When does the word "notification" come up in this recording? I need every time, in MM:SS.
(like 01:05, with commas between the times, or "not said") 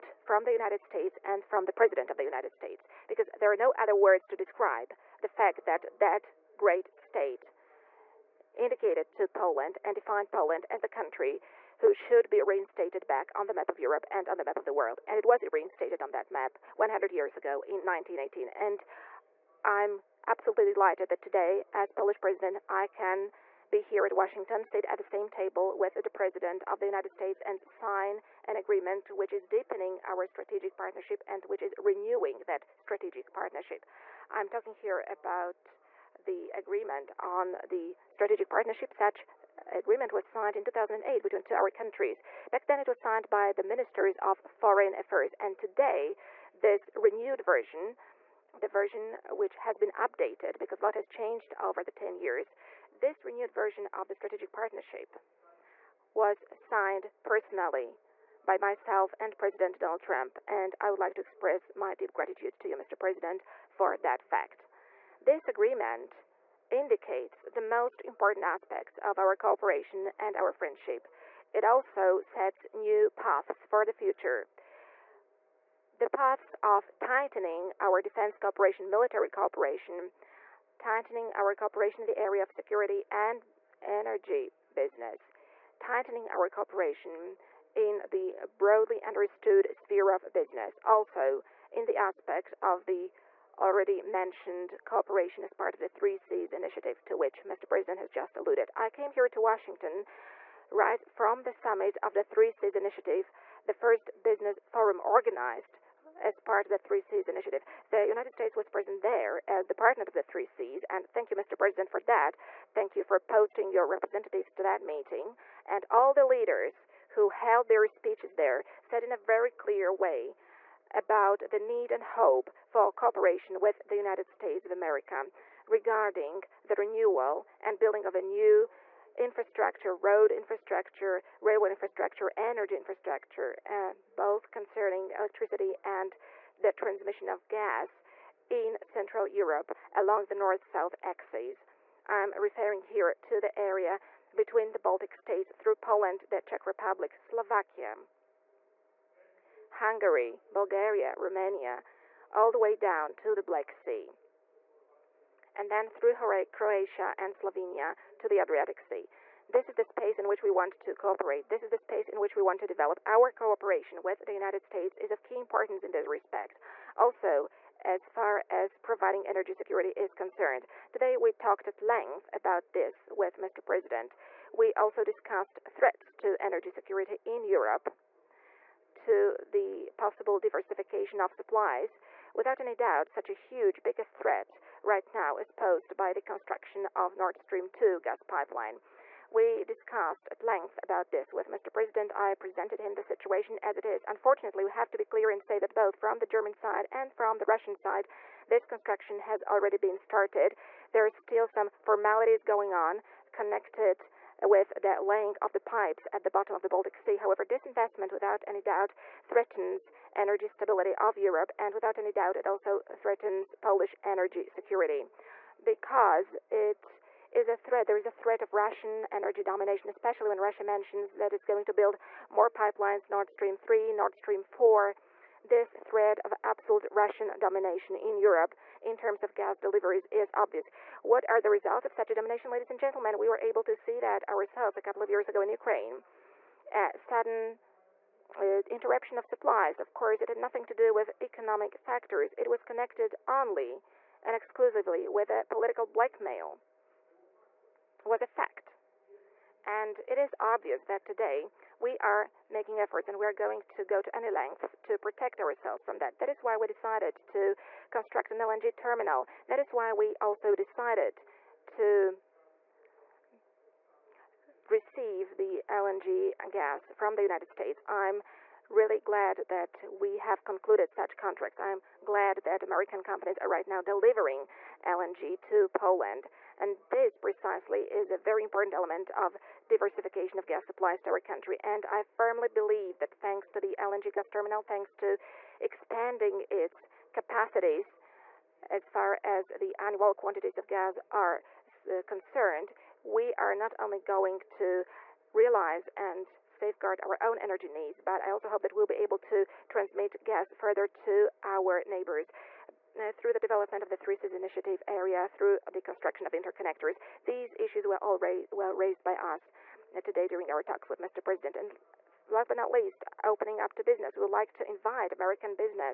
not said.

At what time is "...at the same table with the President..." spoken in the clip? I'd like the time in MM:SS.
00:24.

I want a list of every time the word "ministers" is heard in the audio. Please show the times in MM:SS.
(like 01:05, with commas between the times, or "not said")
00:43.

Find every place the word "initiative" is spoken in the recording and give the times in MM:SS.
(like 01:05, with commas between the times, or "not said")
01:36, 01:42, 01:47, 05:04.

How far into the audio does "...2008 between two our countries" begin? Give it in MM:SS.
00:40.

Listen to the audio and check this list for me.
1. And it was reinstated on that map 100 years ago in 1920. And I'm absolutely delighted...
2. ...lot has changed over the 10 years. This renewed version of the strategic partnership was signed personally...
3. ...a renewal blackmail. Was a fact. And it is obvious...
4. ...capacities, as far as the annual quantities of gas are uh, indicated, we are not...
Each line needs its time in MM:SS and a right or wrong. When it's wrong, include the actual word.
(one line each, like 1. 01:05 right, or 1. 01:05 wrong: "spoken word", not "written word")
1. 00:15 wrong: "1918", not "1920"
2. 00:50 right
3. 04:05 wrong: "political", not "renewal"
4. 04:47 wrong: "concerned", not "indicated".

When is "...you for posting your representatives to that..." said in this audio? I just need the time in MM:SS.
01:52.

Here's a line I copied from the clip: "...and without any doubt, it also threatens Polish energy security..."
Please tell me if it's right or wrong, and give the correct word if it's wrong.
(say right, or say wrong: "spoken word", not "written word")
right.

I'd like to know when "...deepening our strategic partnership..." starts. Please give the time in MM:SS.
00:29.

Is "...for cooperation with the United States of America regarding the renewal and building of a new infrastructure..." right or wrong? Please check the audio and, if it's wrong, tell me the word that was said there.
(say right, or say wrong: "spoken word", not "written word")
right.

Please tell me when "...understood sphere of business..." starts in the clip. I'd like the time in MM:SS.
01:29.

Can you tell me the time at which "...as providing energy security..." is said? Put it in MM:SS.
02:48.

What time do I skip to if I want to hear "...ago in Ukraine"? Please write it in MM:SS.
03:55.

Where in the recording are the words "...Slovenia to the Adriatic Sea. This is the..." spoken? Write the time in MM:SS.
02:37.